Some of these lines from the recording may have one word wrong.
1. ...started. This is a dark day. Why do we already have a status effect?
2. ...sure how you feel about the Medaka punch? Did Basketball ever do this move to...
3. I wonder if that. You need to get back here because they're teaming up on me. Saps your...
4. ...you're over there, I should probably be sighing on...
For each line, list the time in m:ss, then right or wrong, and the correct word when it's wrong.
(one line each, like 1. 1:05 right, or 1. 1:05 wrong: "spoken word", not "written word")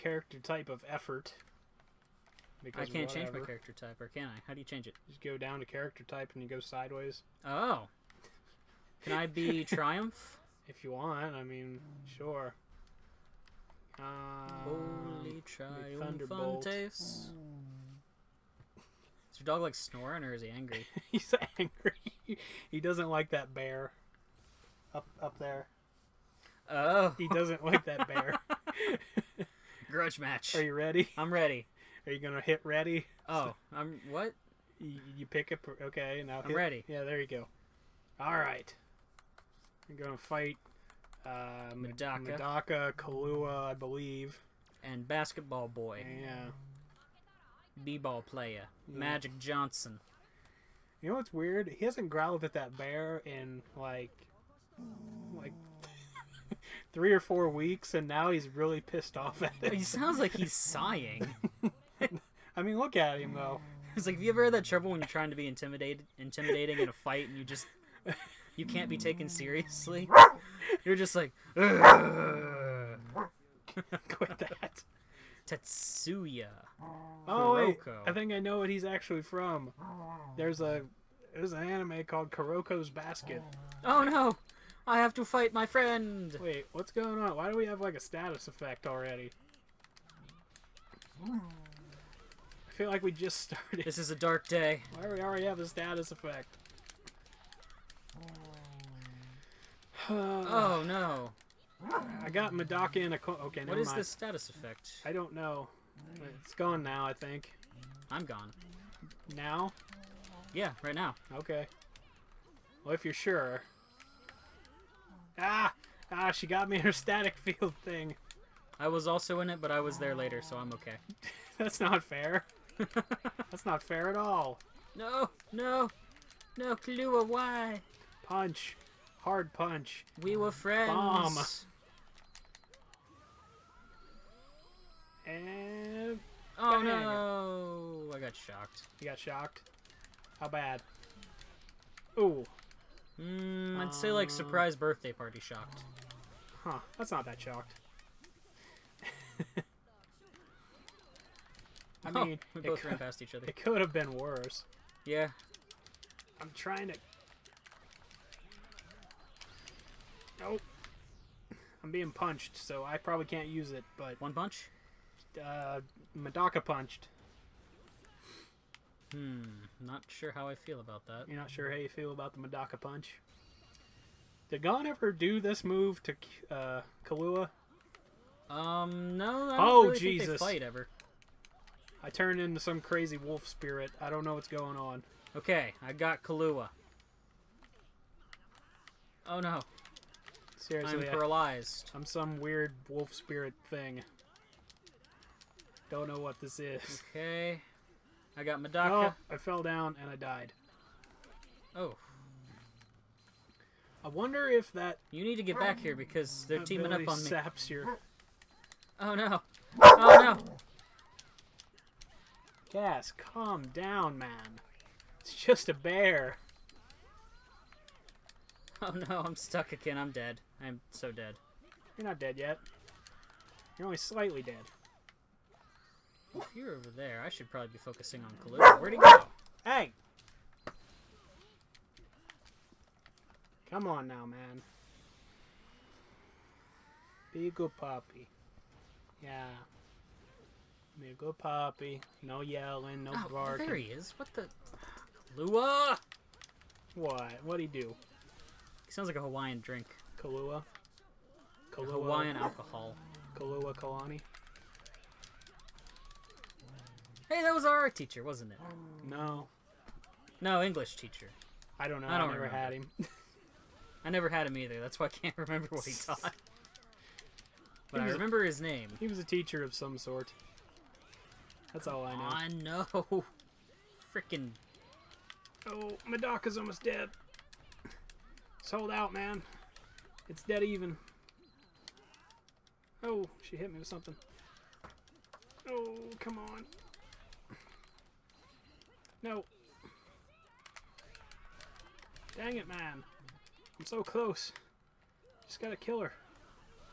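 1. 1:33 right
2. 2:51 wrong: "Gon", not "Basketball"
3. 3:24 right
4. 3:46 wrong: "focusing", not "sighing".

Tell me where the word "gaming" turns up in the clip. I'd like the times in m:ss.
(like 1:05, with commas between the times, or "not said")
not said.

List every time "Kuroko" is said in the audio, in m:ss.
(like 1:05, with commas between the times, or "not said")
1:17, 1:22.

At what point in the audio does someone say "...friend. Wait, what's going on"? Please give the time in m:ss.
1:25.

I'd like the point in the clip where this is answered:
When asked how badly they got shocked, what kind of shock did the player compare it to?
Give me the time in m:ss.
2:24.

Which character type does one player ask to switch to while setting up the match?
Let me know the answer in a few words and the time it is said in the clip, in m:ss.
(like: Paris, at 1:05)
Triumph, at 0:09.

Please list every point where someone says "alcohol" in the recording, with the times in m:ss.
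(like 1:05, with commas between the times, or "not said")
4:12.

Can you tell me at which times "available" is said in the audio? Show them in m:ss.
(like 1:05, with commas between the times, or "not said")
not said.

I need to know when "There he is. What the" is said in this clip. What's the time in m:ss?
4:03.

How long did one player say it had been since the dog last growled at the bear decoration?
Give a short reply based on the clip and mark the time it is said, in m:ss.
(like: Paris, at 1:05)
three or four weeks, at 0:56.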